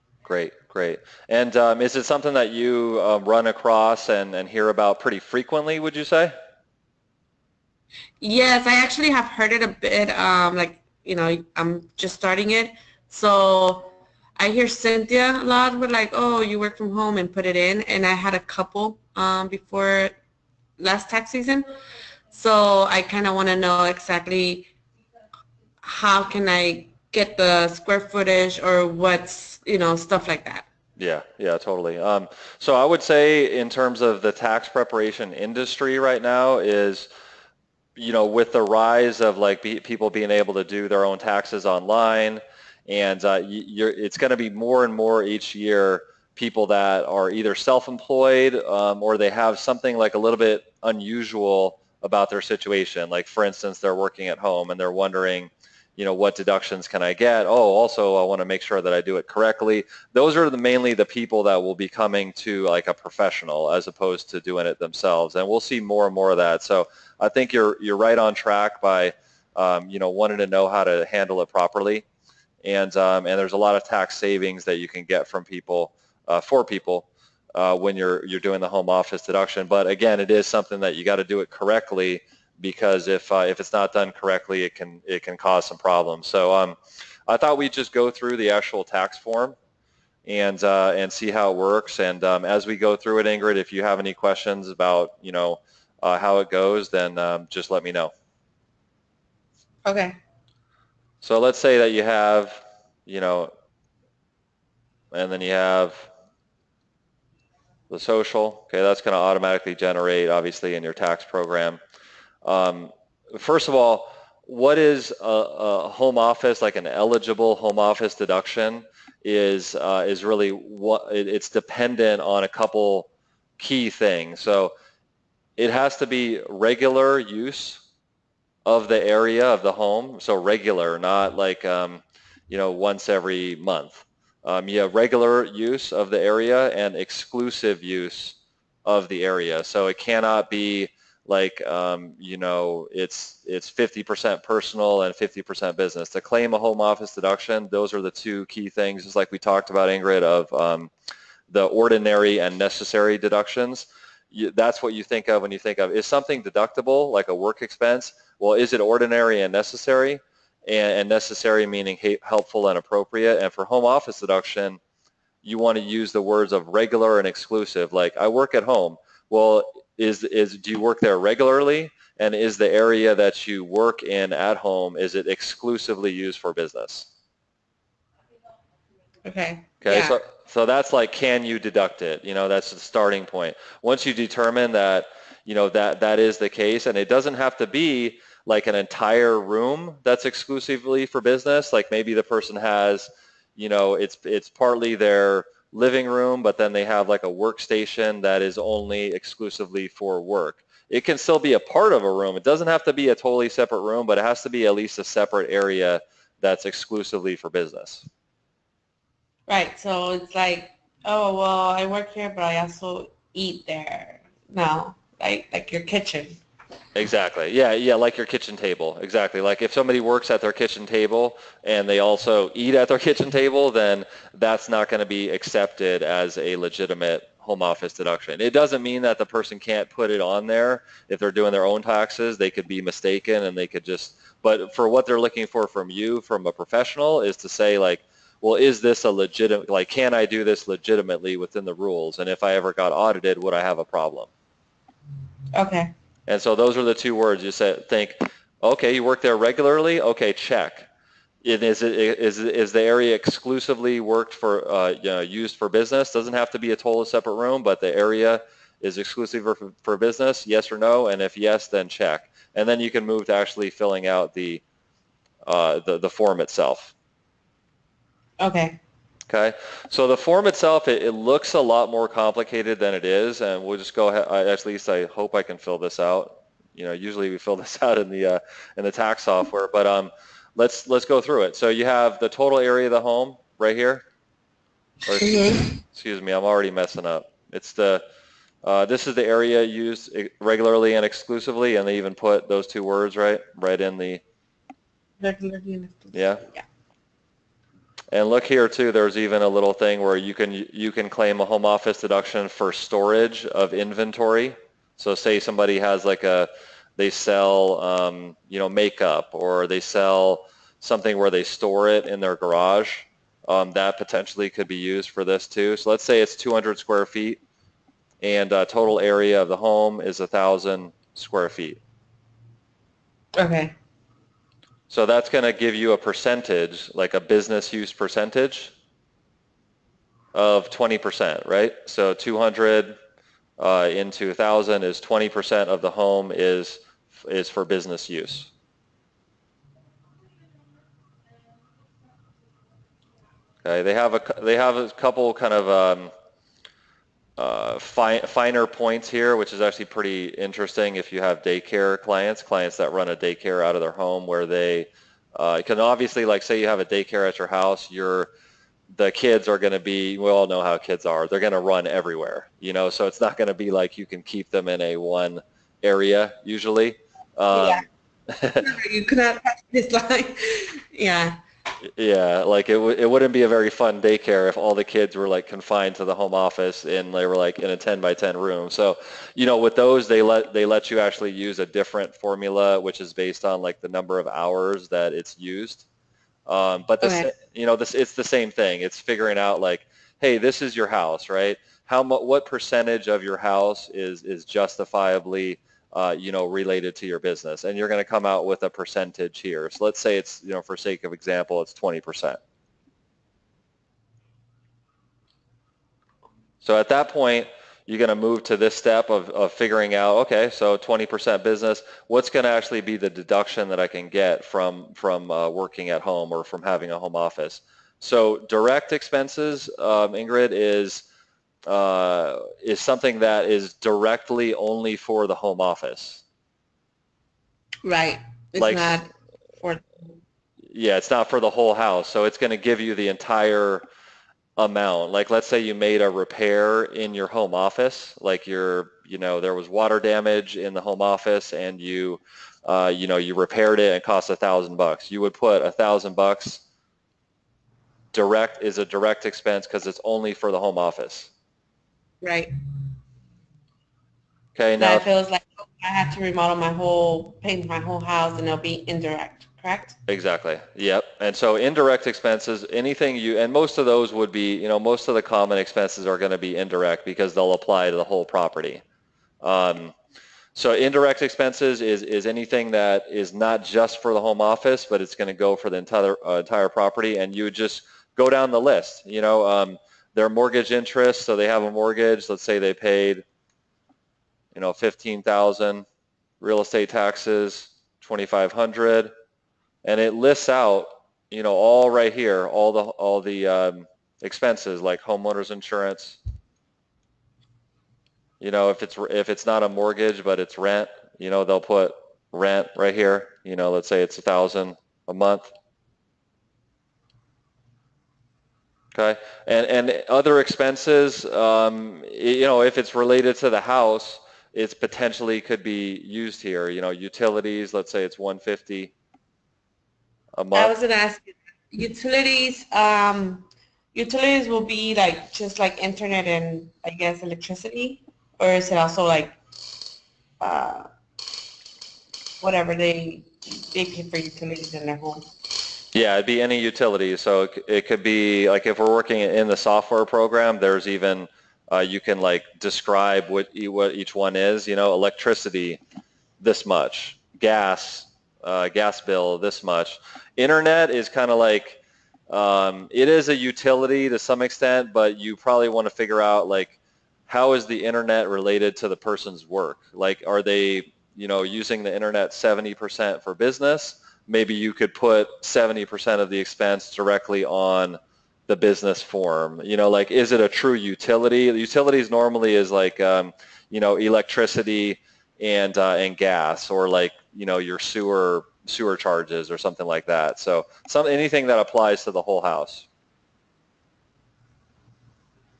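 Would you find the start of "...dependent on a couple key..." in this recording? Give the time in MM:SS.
02:01.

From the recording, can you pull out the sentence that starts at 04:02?
And if I ever got audited, would I have a problem?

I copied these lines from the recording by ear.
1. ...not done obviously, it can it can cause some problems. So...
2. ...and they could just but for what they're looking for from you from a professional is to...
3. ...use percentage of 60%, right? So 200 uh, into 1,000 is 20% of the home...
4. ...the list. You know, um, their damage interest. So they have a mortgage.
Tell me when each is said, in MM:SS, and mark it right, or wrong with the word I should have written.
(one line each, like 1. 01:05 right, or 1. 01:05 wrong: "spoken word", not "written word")
1. 01:23 wrong: "correctly", not "obviously"
2. 03:53 right
3. 05:27 wrong: "20", not "60"
4. 07:58 wrong: "mortgage", not "damage".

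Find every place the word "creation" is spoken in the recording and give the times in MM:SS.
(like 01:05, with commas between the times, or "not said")
not said.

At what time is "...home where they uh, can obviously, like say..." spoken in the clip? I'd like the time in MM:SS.
05:53.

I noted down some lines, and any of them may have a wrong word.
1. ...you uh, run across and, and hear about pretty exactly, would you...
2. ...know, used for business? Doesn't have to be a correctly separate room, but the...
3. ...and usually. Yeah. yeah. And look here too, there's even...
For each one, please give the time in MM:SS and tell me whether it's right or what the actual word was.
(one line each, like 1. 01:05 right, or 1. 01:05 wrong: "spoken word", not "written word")
1. 00:02 wrong: "frequently", not "exactly"
2. 04:15 wrong: "totally", not "correctly"
3. 04:55 wrong: "exclusively", not "usually".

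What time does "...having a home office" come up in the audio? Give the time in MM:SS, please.
06:56.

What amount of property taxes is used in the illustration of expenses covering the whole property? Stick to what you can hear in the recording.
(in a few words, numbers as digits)
2,500.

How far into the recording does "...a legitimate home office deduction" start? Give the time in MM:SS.
03:46.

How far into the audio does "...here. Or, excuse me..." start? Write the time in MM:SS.
04:43.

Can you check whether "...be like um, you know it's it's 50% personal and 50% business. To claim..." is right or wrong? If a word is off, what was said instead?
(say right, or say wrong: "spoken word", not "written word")
right.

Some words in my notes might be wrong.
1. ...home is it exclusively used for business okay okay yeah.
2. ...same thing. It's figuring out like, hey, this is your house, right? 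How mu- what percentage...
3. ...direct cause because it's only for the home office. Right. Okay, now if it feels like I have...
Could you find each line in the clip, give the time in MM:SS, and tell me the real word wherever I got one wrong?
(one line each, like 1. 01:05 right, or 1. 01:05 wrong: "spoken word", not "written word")
1. 02:54 right
2. 06:28 right
3. 07:28 wrong: "expense", not "cause".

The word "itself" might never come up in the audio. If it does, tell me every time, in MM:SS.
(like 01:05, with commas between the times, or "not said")
04:26, 04:30.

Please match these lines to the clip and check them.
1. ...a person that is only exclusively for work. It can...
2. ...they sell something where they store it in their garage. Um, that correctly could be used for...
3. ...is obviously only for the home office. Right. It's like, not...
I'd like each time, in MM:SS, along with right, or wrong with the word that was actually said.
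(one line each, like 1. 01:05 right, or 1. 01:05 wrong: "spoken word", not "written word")
1. 03:17 wrong: "workstation", not "person"
2. 05:09 wrong: "potentially", not "correctly"
3. 07:03 wrong: "directly", not "obviously".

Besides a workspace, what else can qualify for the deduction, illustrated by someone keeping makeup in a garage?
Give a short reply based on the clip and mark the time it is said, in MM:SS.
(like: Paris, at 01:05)
storage of inventory, at 05:02.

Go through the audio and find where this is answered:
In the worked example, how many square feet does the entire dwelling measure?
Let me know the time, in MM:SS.
05:20.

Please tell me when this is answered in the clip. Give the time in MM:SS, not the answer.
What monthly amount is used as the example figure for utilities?
08:38.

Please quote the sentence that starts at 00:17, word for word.
And I had a couple um, before last tax season.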